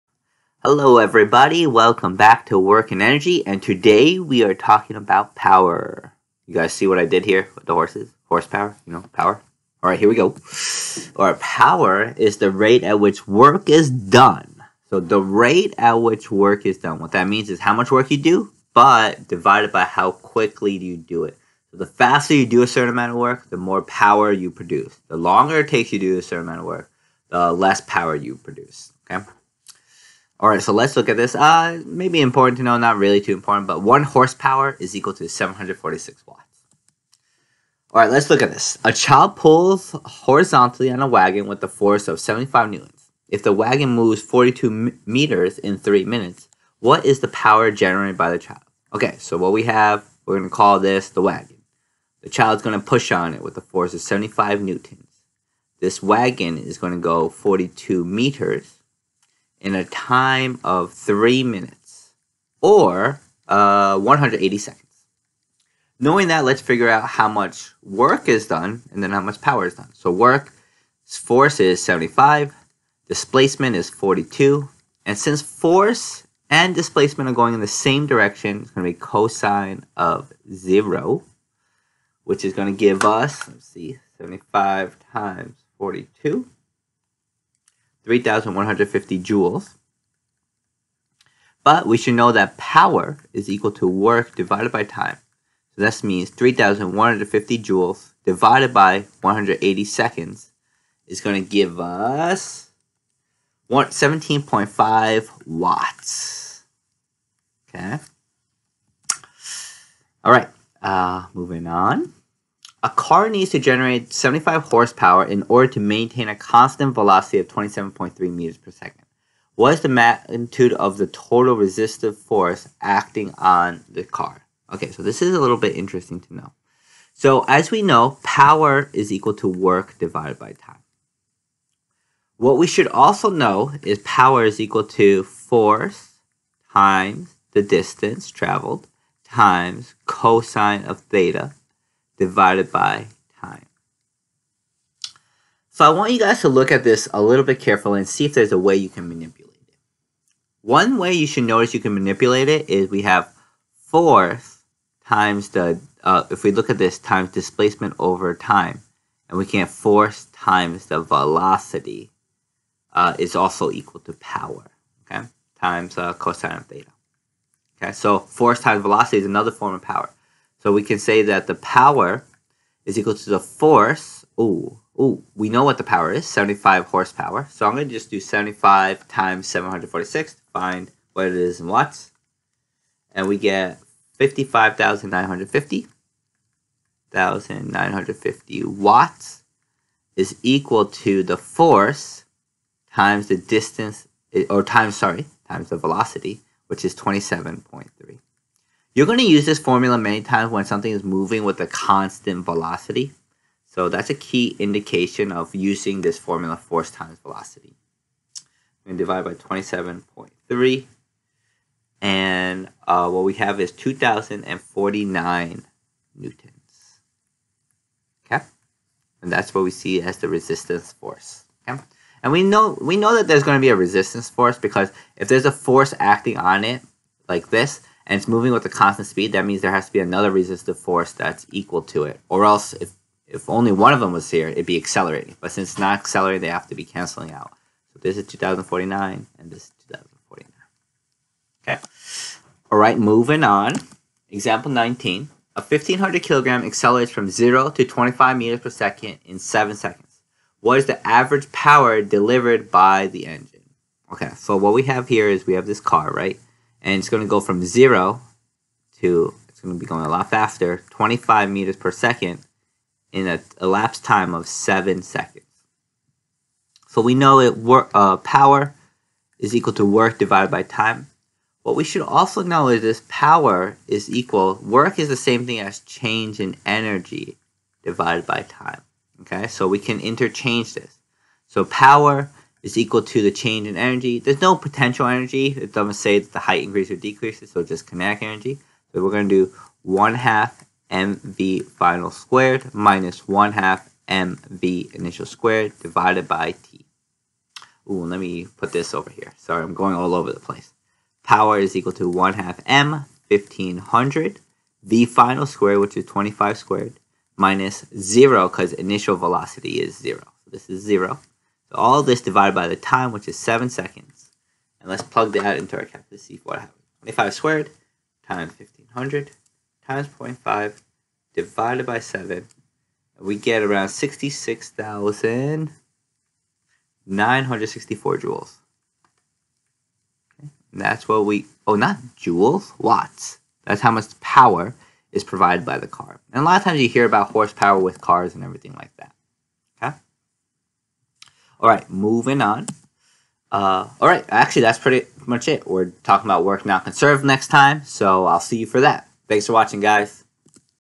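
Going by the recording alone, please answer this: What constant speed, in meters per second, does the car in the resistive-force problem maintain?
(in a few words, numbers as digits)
27.3 meters per second.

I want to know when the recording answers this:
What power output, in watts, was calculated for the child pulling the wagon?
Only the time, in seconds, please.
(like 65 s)
103 s.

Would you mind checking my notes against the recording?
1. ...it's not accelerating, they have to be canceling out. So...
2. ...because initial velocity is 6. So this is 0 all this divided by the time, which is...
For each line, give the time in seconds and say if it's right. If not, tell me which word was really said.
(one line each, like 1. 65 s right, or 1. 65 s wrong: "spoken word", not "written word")
1. 235 s right
2. 308 s wrong: "0", not "6".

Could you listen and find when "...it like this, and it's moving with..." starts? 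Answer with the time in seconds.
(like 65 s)
226 s.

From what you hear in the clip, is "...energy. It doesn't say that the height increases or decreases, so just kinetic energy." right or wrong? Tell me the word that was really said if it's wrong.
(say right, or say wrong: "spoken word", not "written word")
right.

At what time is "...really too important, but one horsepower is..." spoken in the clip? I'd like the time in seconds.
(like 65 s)
32 s.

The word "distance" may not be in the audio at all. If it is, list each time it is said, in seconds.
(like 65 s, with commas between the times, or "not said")
137 s, 193 s.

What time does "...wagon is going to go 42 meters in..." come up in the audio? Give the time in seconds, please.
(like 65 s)
56 s.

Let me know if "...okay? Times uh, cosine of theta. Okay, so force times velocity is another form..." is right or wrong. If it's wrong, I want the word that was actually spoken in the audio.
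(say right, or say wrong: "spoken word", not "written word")
right.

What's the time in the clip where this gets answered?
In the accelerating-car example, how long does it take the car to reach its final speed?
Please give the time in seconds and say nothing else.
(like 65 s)
264 s.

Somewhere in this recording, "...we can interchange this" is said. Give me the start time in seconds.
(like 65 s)
279 s.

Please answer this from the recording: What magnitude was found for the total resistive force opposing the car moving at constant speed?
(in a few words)
2,049 newtons.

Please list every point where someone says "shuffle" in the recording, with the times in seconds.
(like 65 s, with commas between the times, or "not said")
not said.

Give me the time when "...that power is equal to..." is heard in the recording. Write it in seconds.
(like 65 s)
92 s.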